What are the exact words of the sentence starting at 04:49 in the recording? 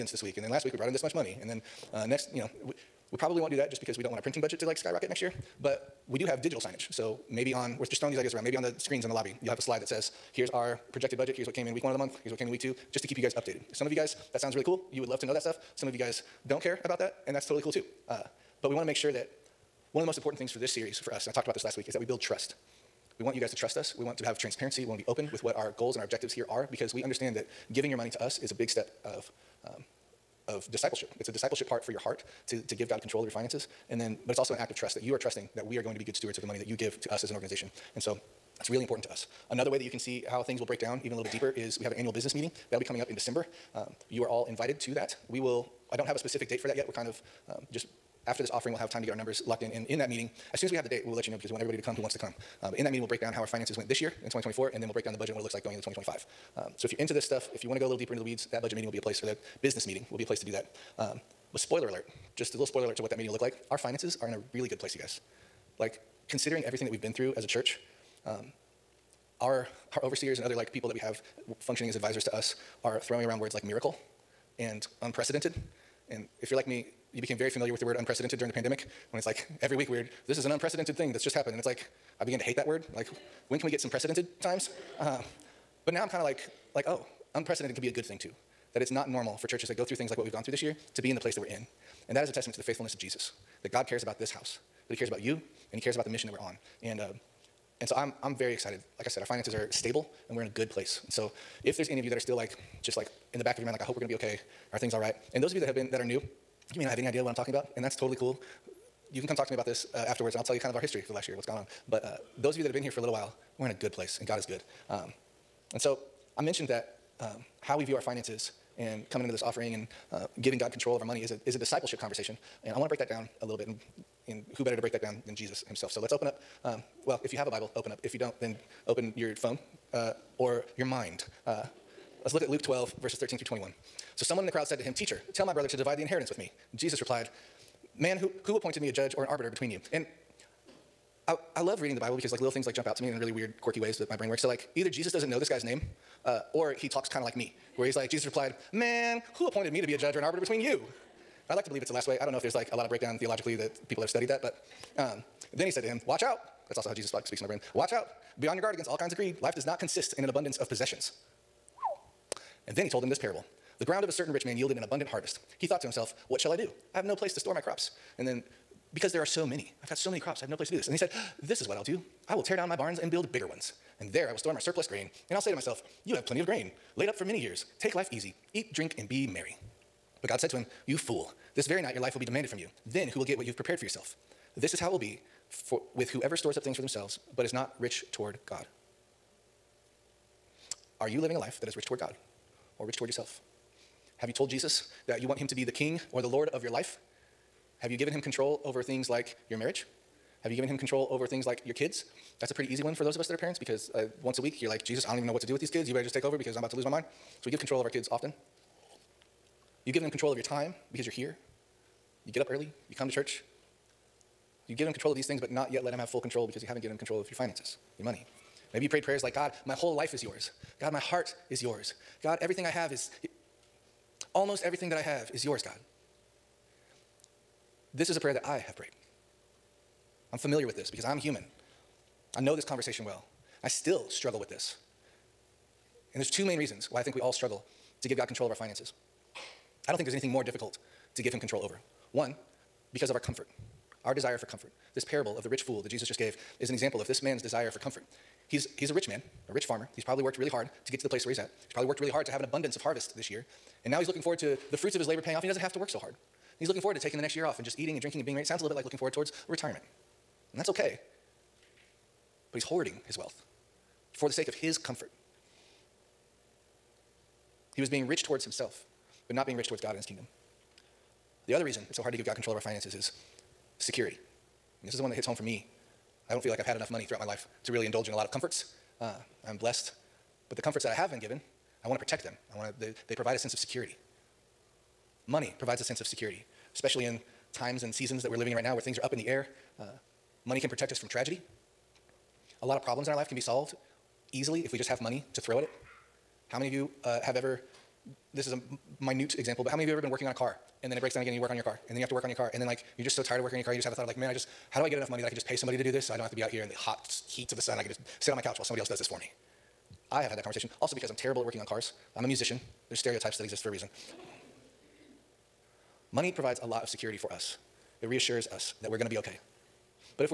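Uh, money can protect us from tragedy.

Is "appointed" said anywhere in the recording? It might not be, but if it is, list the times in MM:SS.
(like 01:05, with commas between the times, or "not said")
02:18, 02:29.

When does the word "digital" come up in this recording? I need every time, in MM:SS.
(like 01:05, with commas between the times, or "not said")
00:06.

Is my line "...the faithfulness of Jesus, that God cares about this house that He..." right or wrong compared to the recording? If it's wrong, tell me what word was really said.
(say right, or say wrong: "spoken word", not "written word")
right.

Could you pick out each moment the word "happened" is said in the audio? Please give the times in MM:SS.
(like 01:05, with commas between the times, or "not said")
01:21.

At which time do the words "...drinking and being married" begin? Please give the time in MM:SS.
04:18.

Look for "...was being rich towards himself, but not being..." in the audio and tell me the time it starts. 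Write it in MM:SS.
04:27.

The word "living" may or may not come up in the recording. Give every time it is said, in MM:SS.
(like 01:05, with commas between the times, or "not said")
03:11, 04:48.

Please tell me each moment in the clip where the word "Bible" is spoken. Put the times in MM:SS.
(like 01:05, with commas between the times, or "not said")
02:07, 02:21.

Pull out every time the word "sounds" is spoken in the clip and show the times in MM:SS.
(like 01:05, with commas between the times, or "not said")
00:14, 04:18.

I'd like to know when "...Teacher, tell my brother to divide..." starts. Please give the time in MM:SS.
02:14.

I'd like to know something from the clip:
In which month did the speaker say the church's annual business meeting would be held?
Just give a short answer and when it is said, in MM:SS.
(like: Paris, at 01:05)
December, at 00:43.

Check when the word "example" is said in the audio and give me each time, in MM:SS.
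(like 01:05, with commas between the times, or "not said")
04:06, 04:59.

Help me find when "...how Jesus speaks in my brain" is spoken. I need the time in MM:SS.
02:36.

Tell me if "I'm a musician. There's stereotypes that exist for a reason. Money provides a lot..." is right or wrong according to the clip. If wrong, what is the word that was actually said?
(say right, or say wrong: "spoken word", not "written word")
right.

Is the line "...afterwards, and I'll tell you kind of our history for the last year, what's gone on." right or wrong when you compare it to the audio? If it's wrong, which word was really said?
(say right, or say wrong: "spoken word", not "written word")
right.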